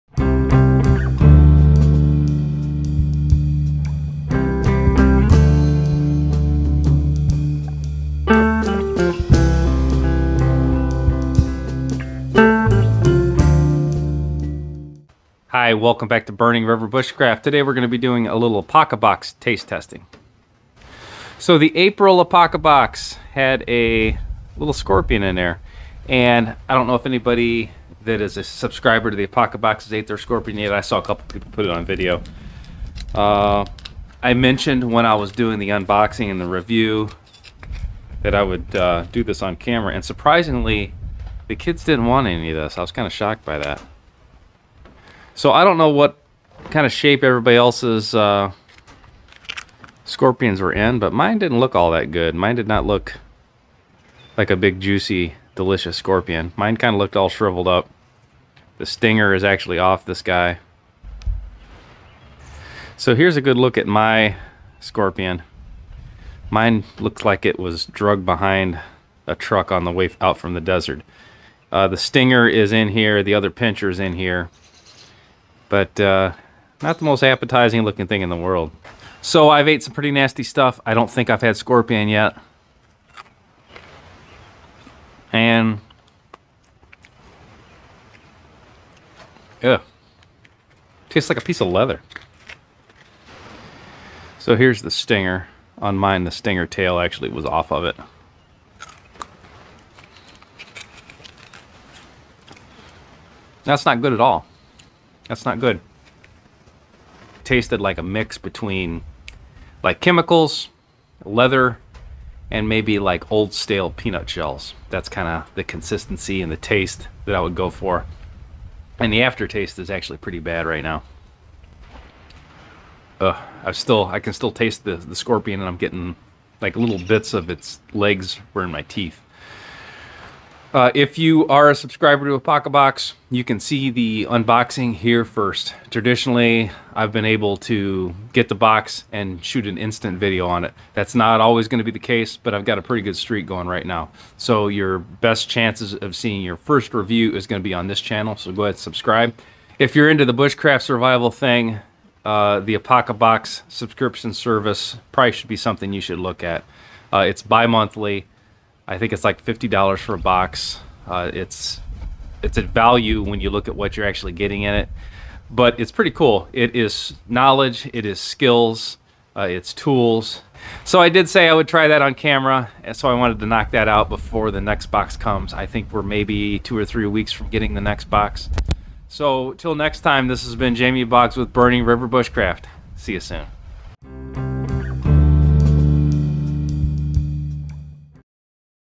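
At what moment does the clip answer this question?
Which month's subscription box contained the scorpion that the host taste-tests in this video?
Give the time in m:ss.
0:21.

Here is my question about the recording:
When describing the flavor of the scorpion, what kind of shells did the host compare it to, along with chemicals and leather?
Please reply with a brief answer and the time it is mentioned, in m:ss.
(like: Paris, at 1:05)
Old stale peanut shells, at 1:53.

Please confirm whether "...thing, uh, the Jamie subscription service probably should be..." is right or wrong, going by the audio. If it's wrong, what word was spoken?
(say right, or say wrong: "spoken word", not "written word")
wrong: "Apocabox", not "Jamie".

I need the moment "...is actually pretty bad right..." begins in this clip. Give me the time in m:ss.
1:59.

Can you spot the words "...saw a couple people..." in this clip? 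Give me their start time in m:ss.
0:30.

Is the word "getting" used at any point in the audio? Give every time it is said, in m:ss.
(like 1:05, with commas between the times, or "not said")
2:05, 2:44, 2:57.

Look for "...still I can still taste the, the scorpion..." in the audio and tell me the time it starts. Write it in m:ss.
2:03.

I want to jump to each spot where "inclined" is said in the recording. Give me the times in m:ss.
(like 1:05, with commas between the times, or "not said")
not said.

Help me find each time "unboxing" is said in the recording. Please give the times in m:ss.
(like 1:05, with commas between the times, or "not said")
0:35, 2:14.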